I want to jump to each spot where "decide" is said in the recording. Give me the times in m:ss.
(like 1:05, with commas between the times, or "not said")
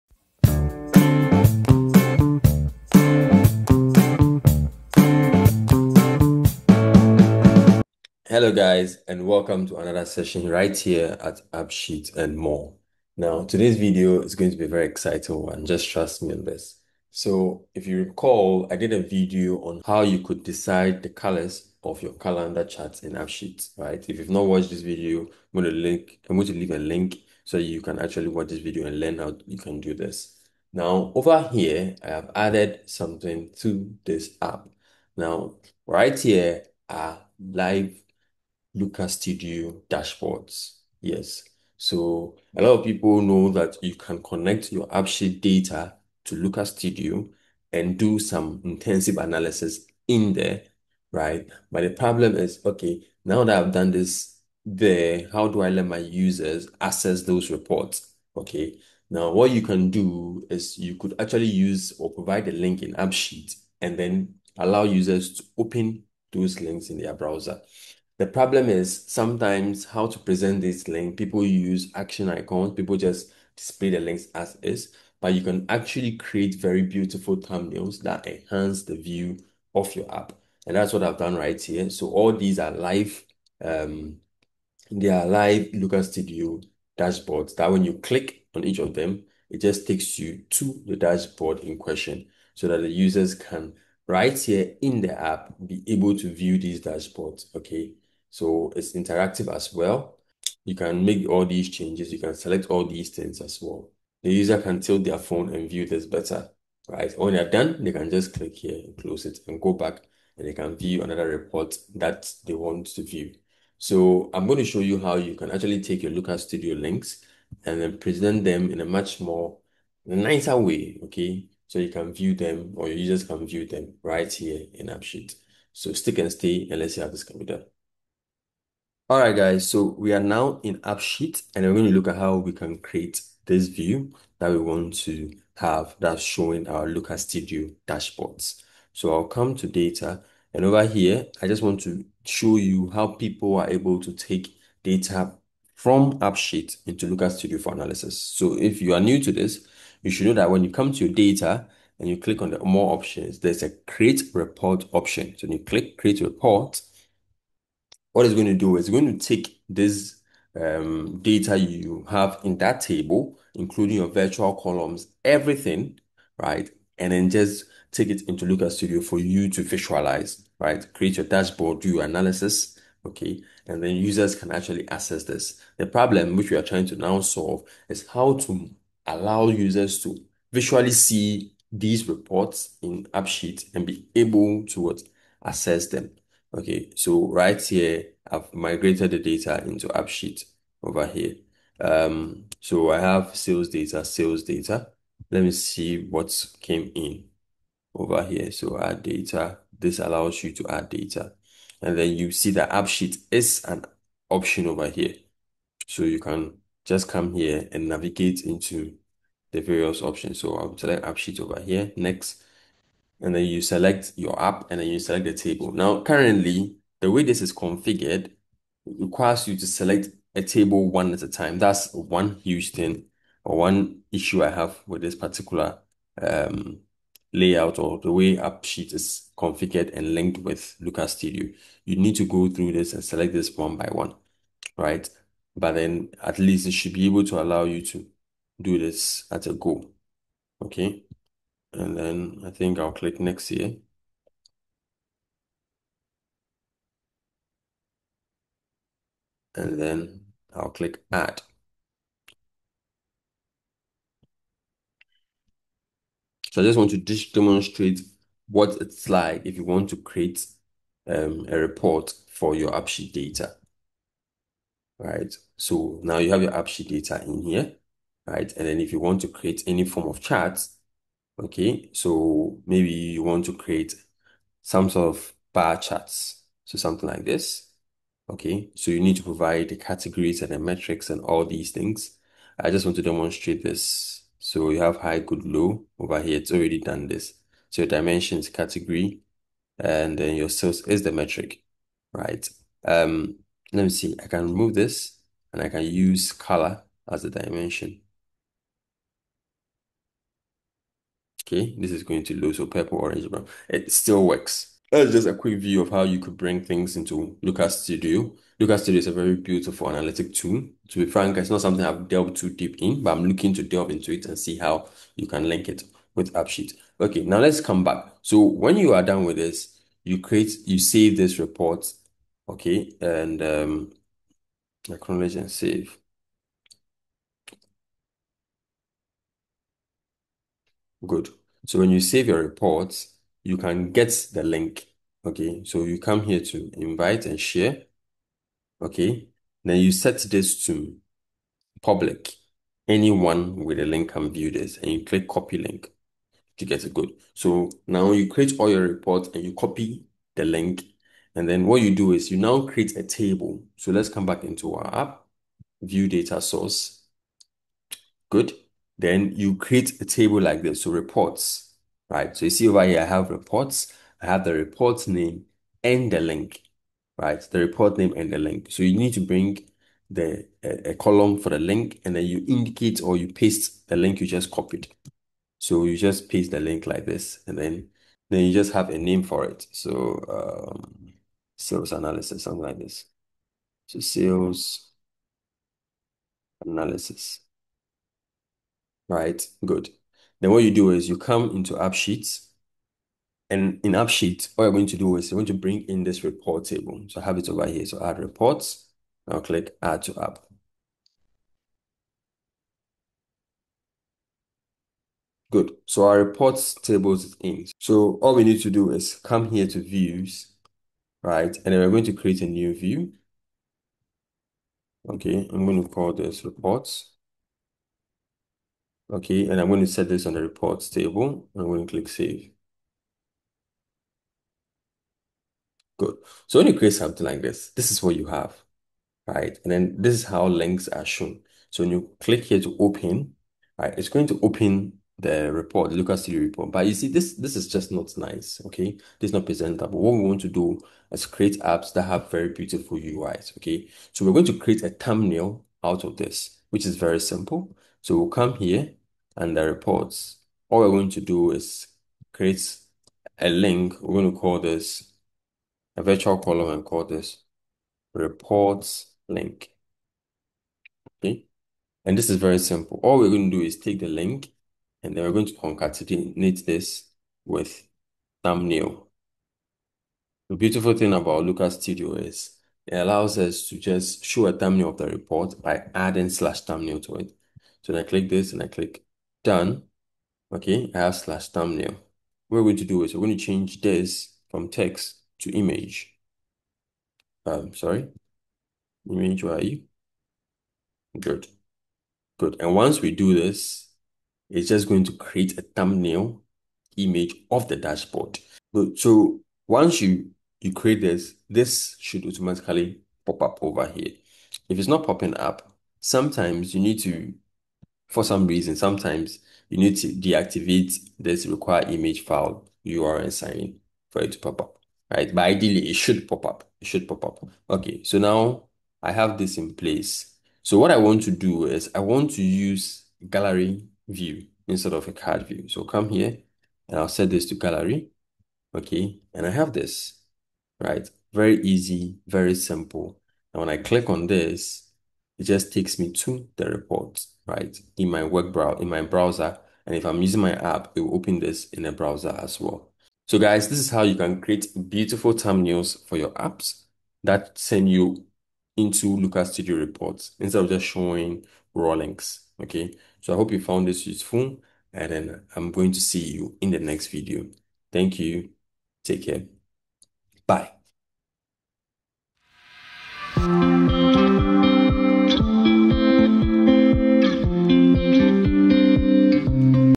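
0:20.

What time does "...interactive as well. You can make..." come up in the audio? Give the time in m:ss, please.
1:38.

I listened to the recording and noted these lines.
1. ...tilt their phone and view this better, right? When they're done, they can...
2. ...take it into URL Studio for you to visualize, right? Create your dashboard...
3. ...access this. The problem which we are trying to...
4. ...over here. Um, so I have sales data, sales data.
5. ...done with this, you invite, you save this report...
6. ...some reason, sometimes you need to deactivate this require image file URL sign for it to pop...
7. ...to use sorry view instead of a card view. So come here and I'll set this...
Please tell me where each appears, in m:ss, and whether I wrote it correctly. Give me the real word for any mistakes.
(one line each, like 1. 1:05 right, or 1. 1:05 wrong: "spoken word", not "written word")
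1. 1:44 right
2. 2:47 wrong: "Looker", not "URL"
3. 2:54 right
4. 3:10 right
5. 5:19 wrong: "create", not "invite"
6. 8:28 right
7. 8:42 wrong: "gallery", not "sorry".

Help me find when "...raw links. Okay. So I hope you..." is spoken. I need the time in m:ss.
9:11.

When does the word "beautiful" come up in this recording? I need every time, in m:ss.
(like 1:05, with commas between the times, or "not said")
1:16, 5:09, 7:22, 7:50, 9:04.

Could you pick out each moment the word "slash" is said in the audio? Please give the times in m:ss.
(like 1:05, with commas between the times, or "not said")
7:56, 8:01.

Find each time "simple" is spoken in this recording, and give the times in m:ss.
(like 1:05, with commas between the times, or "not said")
7:27, 7:42, 8:52.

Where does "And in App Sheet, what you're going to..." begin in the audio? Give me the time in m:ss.
6:33.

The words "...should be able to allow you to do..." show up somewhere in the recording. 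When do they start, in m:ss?
3:56.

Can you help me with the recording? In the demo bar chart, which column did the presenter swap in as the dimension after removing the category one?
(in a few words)
Color.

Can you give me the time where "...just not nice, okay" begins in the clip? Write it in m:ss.
7:17.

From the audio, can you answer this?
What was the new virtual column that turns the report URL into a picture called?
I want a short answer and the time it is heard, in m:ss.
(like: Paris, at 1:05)
Reports link, at 7:38.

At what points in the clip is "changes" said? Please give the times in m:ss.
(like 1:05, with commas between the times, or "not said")
1:41, 8:03.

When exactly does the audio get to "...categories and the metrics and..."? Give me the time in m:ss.
4:39.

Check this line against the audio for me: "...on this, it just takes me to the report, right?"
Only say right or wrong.
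right.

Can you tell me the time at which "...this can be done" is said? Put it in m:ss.
2:07.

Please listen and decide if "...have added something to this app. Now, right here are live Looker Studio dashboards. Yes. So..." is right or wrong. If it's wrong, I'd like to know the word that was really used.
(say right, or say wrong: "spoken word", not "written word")
right.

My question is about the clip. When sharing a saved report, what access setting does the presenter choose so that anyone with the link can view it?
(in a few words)
Public.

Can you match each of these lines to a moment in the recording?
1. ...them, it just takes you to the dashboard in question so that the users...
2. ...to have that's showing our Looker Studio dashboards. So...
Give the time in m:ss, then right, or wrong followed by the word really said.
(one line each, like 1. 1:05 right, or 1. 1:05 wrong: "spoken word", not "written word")
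1. 1:28 right
2. 2:15 right.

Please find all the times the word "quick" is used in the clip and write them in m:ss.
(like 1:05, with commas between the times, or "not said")
5:05.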